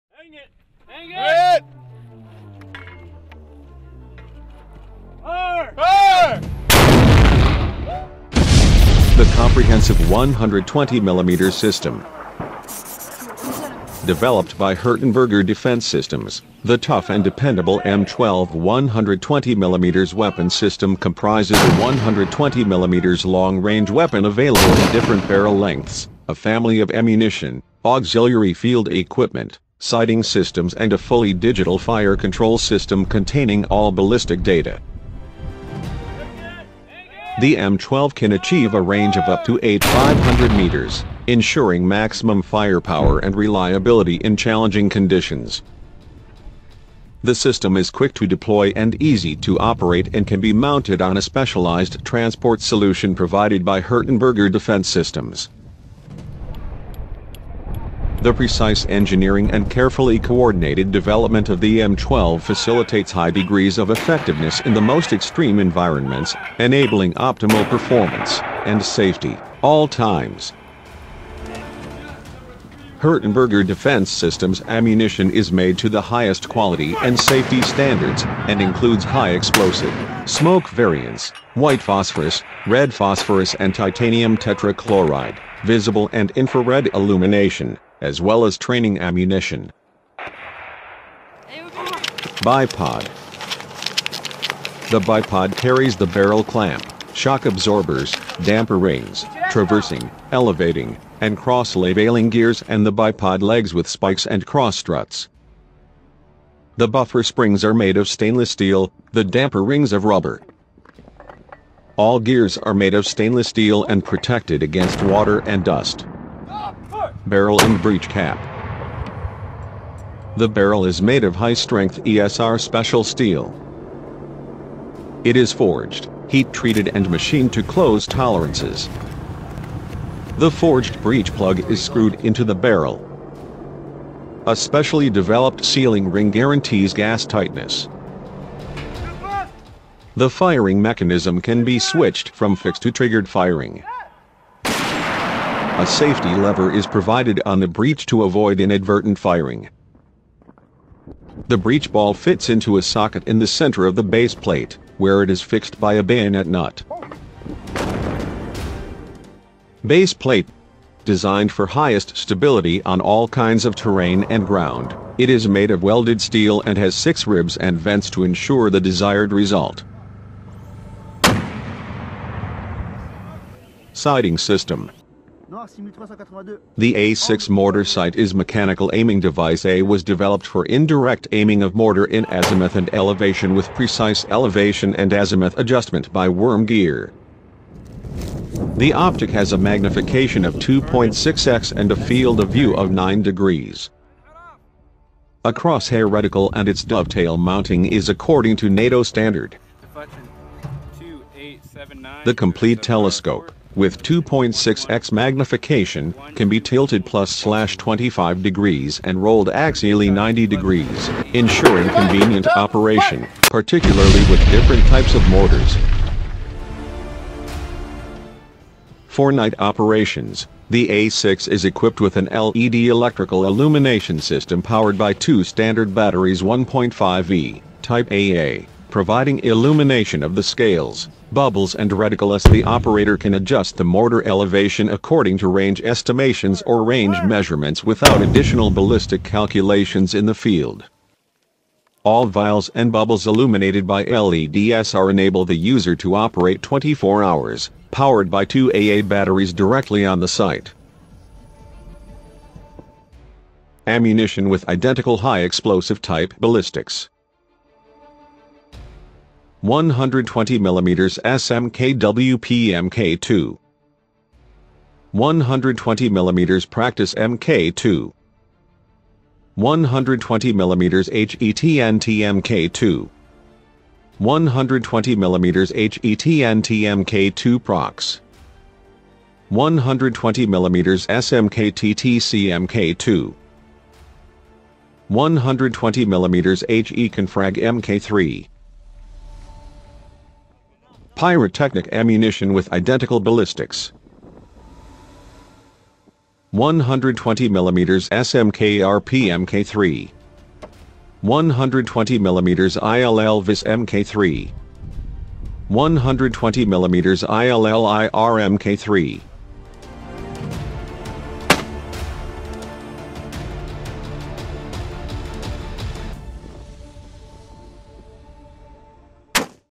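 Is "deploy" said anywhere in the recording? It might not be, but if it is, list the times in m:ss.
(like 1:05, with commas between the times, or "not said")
0:48.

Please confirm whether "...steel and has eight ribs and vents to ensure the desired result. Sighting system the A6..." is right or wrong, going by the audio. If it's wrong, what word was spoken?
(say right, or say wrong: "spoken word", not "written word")
wrong: "six", not "eight".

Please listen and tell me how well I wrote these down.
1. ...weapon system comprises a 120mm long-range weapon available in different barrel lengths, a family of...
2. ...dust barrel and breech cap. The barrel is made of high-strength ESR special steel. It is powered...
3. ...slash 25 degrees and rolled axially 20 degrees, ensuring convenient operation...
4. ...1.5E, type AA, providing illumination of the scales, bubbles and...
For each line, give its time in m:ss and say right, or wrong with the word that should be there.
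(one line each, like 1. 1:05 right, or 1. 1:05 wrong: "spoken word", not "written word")
1. 0:20 right
2. 1:55 wrong: "forged", not "powered"
3. 3:27 wrong: "90", not "20"
4. 3:46 right.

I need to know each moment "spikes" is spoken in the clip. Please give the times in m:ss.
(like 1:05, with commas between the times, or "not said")
1:43.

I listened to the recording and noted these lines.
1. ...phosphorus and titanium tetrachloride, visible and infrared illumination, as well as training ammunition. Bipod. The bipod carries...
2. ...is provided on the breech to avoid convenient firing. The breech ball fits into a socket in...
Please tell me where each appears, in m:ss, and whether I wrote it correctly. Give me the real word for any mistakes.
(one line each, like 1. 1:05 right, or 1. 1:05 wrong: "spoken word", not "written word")
1. 1:22 right
2. 2:26 wrong: "inadvertent", not "convenient".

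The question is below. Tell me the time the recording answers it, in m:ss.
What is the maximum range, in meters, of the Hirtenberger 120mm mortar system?
0:39.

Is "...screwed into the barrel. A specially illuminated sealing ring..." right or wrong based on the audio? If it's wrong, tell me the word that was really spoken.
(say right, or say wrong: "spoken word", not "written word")
wrong: "developed", not "illuminated".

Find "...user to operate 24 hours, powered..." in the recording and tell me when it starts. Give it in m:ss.
4:05.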